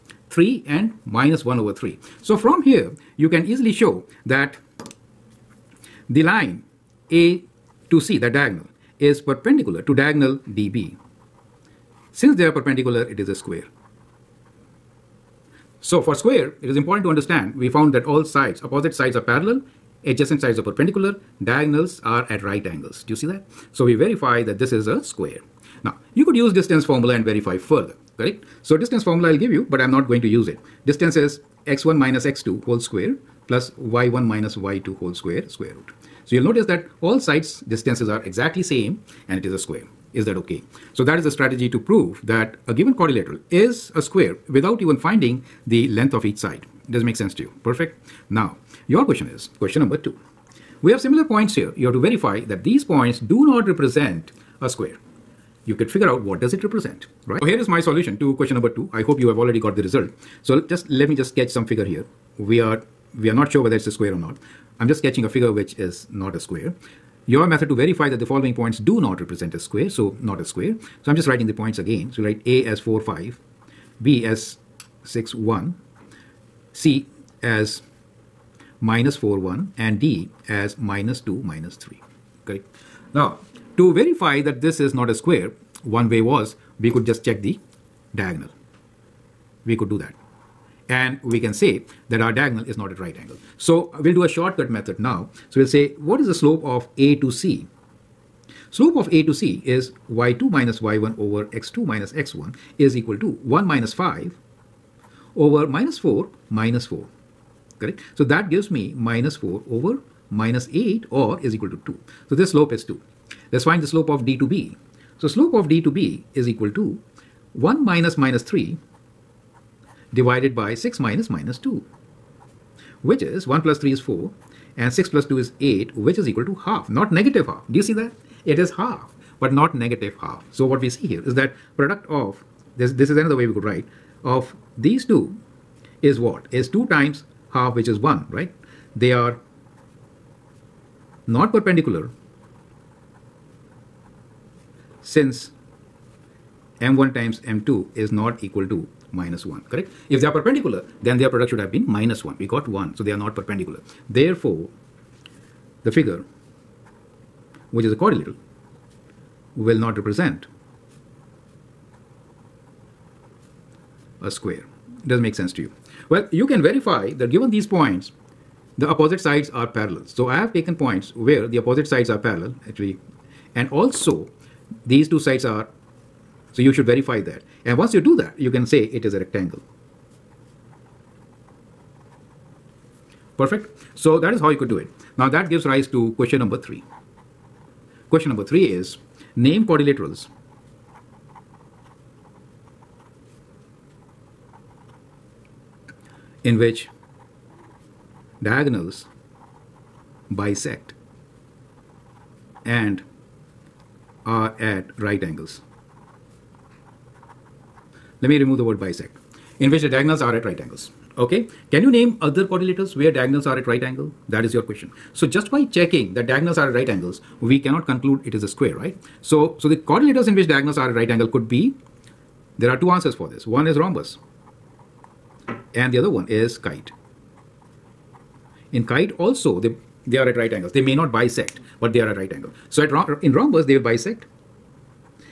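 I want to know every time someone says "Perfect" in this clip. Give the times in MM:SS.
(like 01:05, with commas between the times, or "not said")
00:47, 03:03.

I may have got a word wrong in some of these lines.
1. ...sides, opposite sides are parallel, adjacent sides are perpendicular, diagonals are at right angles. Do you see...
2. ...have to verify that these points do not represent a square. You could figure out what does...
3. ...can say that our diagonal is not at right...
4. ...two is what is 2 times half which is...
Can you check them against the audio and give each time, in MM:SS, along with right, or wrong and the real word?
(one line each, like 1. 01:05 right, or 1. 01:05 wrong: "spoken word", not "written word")
1. 00:18 right
2. 00:51 right
3. 01:31 right
4. 02:15 right.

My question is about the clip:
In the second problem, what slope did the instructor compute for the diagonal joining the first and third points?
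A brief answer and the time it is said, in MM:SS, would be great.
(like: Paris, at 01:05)
2, at 01:51.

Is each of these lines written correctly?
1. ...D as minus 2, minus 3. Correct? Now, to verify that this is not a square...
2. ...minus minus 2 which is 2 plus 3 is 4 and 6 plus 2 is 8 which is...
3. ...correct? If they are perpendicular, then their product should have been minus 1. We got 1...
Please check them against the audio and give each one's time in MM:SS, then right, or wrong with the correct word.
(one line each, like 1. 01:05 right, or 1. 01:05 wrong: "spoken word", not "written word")
1. 01:20 right
2. 02:01 wrong: "1", not "2"
3. 02:29 right.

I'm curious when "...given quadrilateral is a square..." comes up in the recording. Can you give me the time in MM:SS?
00:42.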